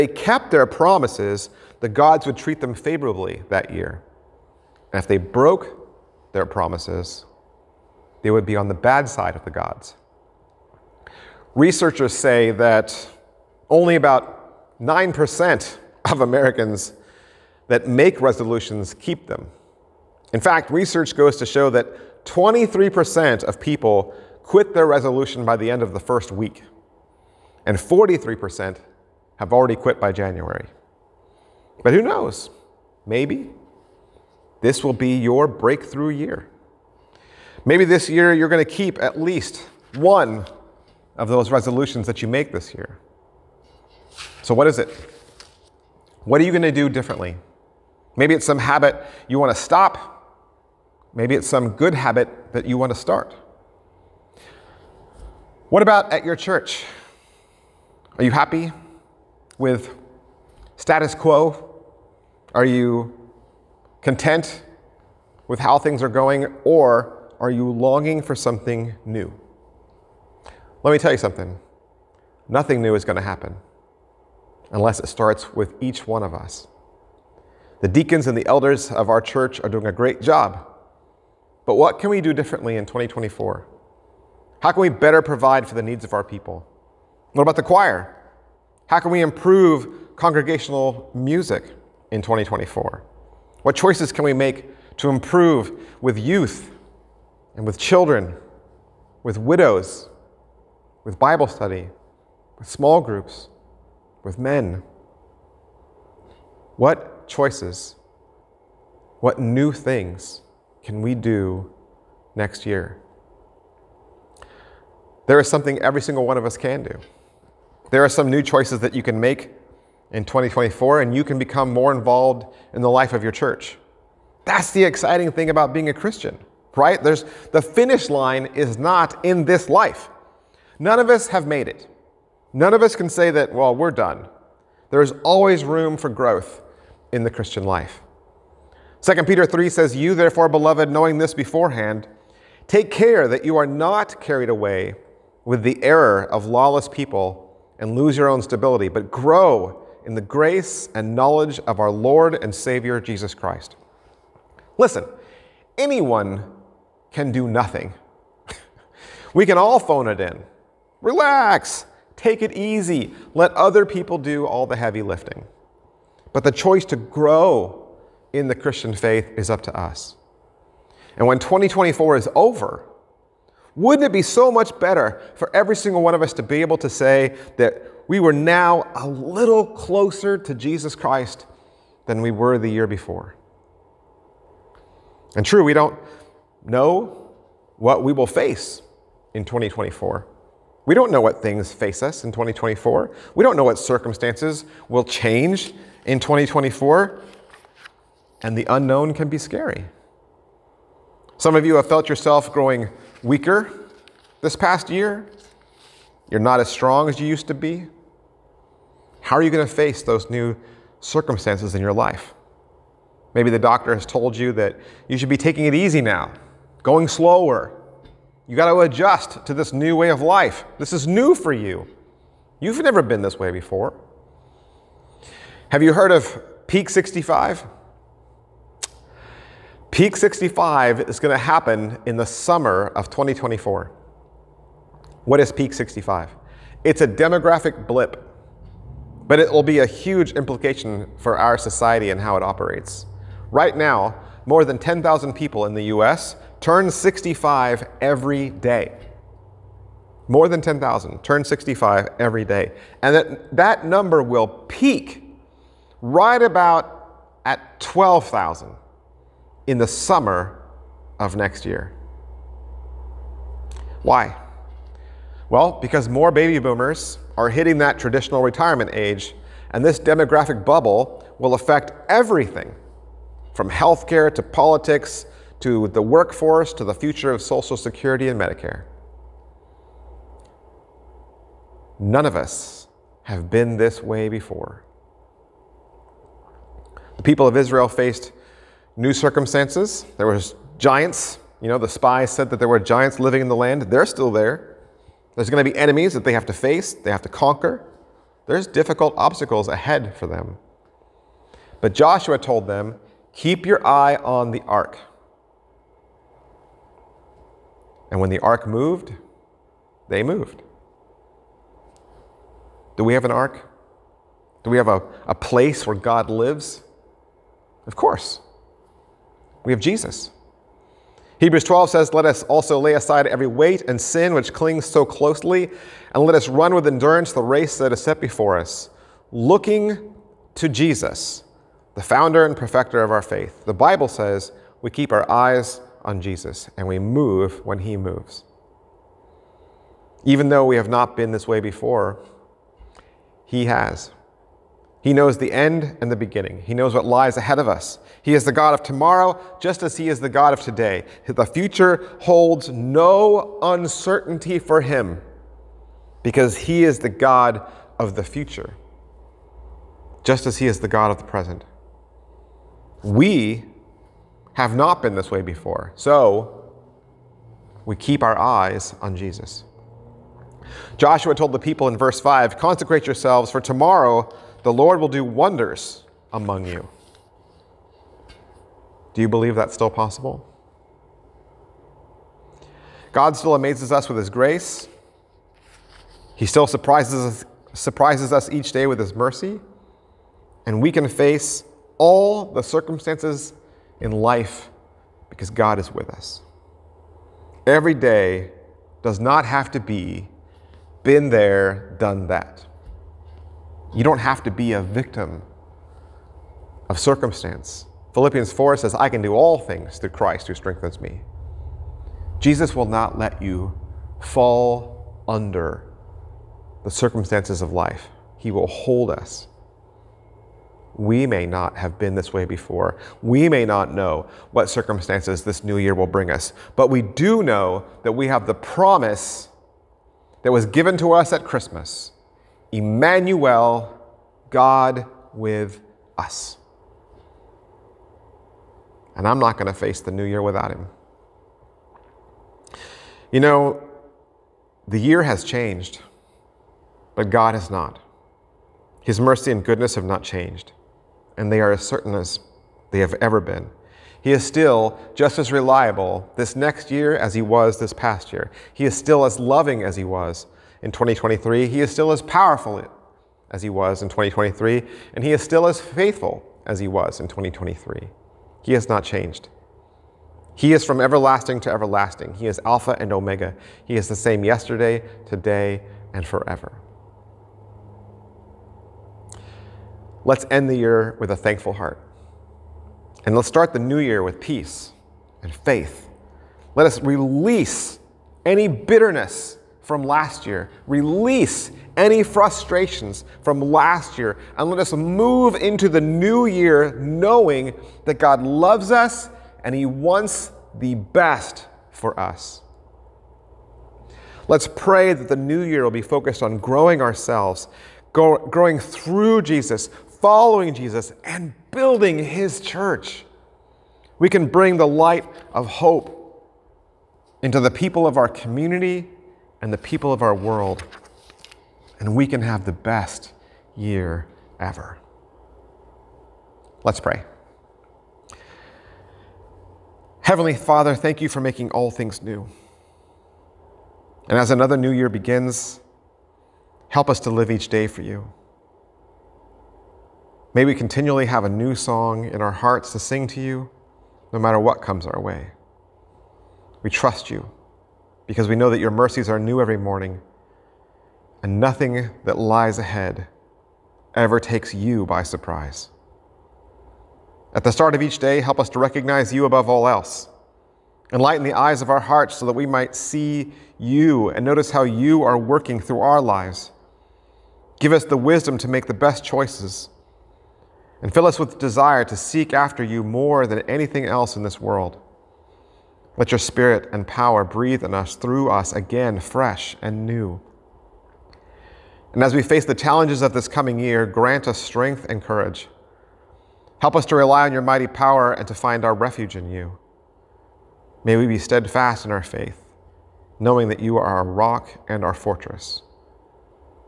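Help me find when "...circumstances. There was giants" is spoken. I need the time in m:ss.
4:49.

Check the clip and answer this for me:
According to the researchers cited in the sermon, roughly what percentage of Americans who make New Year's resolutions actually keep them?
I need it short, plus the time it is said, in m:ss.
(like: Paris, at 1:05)
9%, at 0:14.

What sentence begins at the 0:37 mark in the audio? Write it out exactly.
Maybe this year you're going to keep at least one of those resolutions that you make this year.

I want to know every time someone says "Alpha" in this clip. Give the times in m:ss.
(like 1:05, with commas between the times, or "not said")
7:52.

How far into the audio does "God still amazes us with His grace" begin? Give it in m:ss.
6:23.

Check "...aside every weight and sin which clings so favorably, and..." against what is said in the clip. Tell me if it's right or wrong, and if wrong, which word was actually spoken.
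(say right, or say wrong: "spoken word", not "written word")
wrong: "closely", not "favorably".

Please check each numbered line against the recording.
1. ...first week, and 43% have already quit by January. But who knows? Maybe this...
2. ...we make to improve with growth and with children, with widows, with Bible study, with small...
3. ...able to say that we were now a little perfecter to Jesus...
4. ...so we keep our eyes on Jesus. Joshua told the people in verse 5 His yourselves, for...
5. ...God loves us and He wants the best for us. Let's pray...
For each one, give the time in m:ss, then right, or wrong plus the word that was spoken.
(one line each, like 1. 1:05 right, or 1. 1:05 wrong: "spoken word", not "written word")
1. 0:25 right
2. 1:34 wrong: "youth", not "growth"
3. 2:56 wrong: "closer", not "perfecter"
4. 6:05 wrong: "Consecrate", not "His"
5. 8:18 right.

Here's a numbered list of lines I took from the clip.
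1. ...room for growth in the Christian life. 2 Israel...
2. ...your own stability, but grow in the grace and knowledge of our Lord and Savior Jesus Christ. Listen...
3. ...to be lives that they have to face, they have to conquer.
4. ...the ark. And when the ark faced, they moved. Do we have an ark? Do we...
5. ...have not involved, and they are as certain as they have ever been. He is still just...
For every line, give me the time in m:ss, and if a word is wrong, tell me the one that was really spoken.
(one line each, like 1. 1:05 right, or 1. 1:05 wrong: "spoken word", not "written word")
1. 2:15 wrong: "Peter", not "Israel"
2. 2:28 right
3. 4:55 wrong: "enemies", not "lives"
4. 5:04 wrong: "moved", not "faced"
5. 7:29 wrong: "changed", not "involved".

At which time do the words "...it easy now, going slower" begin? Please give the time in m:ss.
3:35.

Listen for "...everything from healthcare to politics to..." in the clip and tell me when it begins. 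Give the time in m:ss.
4:32.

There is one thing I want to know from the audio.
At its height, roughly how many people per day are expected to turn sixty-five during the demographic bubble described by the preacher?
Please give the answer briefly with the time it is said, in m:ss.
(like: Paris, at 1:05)
12,000, at 4:17.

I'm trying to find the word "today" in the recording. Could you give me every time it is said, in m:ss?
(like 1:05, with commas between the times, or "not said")
5:50, 7:55.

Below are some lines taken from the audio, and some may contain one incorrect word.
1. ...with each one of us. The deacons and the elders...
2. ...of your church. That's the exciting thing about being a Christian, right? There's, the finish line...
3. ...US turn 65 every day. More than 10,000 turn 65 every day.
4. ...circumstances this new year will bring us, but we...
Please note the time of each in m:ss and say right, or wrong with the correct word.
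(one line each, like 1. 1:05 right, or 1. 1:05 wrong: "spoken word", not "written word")
1. 1:15 right
2. 2:03 right
3. 4:05 right
4. 7:04 right.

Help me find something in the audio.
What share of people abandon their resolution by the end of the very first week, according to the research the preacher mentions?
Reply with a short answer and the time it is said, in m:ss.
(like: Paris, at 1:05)
23%, at 0:22.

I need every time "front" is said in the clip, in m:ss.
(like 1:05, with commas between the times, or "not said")
not said.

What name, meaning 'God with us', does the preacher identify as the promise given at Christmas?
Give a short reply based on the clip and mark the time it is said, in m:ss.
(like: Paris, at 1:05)
Emmanuel, at 7:12.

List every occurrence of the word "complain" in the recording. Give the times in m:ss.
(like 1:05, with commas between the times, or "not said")
not said.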